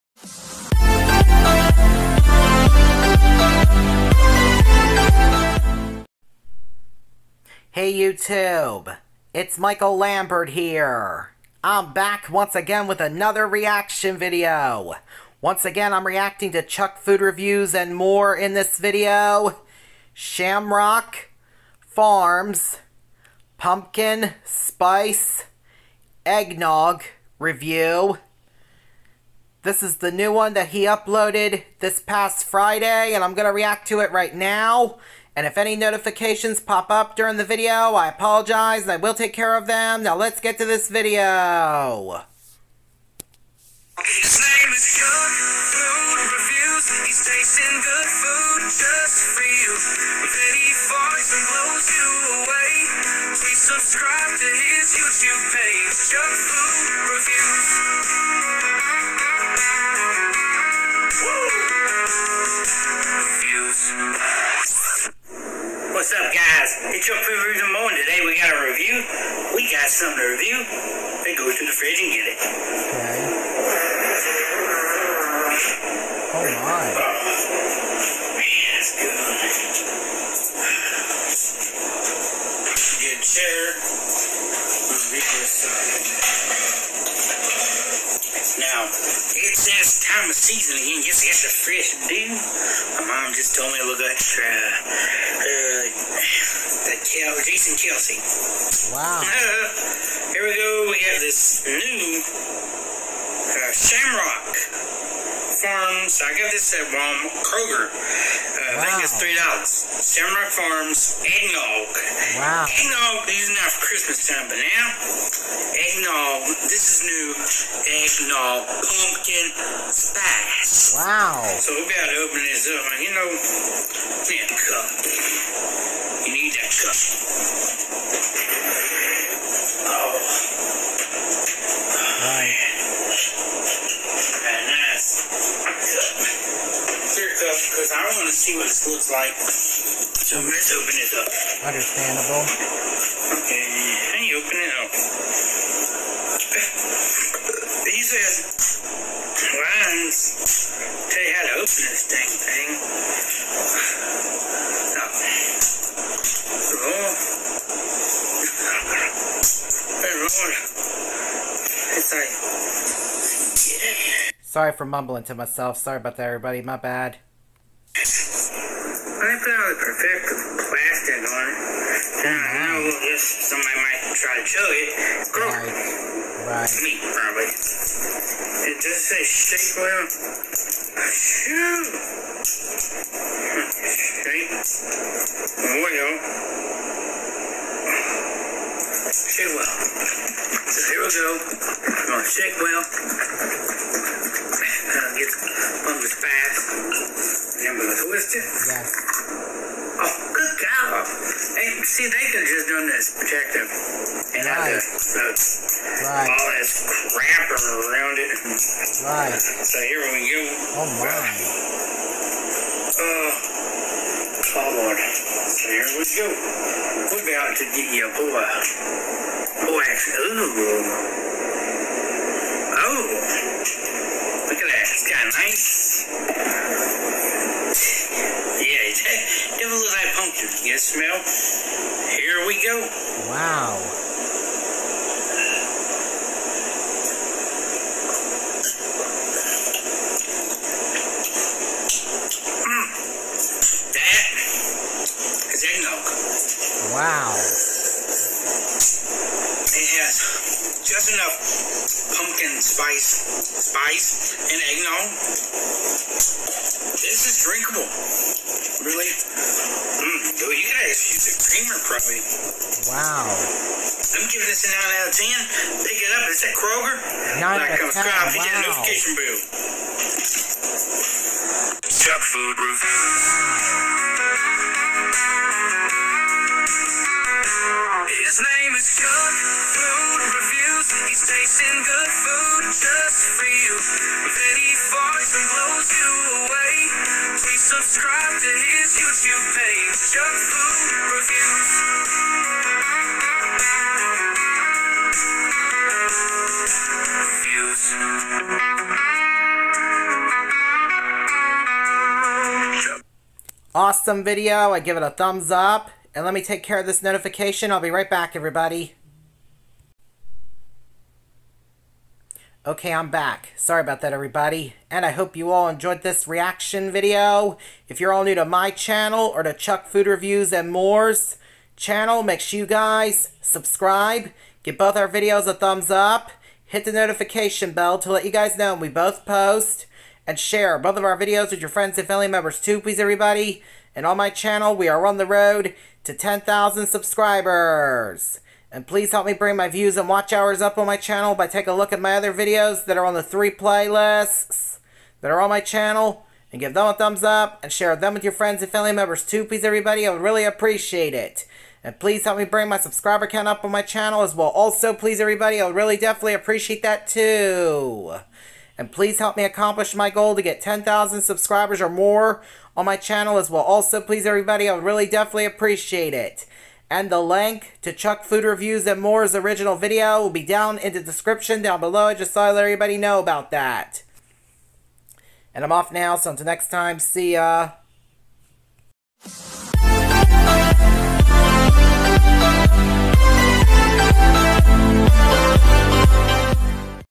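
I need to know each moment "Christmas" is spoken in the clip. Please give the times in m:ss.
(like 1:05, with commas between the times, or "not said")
1:53.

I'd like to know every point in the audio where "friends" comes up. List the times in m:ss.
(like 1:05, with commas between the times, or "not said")
5:31, 5:48.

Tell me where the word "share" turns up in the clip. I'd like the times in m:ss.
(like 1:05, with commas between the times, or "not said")
5:30, 5:47.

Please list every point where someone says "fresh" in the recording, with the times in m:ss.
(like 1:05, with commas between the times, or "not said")
1:31.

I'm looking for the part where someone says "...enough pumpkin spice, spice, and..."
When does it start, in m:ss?
4:11.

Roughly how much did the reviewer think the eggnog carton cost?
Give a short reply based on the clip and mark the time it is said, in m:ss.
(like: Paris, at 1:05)
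3 dollars, at 1:49.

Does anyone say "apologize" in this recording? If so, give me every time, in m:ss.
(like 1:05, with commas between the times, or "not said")
0:38.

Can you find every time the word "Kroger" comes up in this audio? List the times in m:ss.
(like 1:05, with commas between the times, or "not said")
1:47, 4:26.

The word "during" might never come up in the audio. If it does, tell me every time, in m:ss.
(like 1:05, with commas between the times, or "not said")
0:37.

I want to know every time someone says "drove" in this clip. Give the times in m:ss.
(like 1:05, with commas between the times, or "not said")
not said.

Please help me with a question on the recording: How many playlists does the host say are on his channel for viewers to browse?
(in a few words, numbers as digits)
3.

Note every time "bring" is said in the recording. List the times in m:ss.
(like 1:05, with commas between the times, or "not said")
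5:39, 5:52.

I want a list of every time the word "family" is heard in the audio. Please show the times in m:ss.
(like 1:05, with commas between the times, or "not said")
5:32, 5:48.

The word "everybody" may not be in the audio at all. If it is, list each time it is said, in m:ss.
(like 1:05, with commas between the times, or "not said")
2:46, 5:08, 5:14, 5:32, 5:49, 5:55, 6:04, 6:12.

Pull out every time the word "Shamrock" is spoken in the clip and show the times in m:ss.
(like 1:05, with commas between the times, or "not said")
0:20, 1:43, 1:49.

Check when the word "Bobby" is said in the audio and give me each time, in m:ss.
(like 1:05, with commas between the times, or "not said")
not said.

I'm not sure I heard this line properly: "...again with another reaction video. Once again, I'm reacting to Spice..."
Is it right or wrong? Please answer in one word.
wrong.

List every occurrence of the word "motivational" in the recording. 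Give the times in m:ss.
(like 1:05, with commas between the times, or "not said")
not said.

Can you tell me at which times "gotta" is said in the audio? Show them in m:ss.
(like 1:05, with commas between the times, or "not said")
2:01.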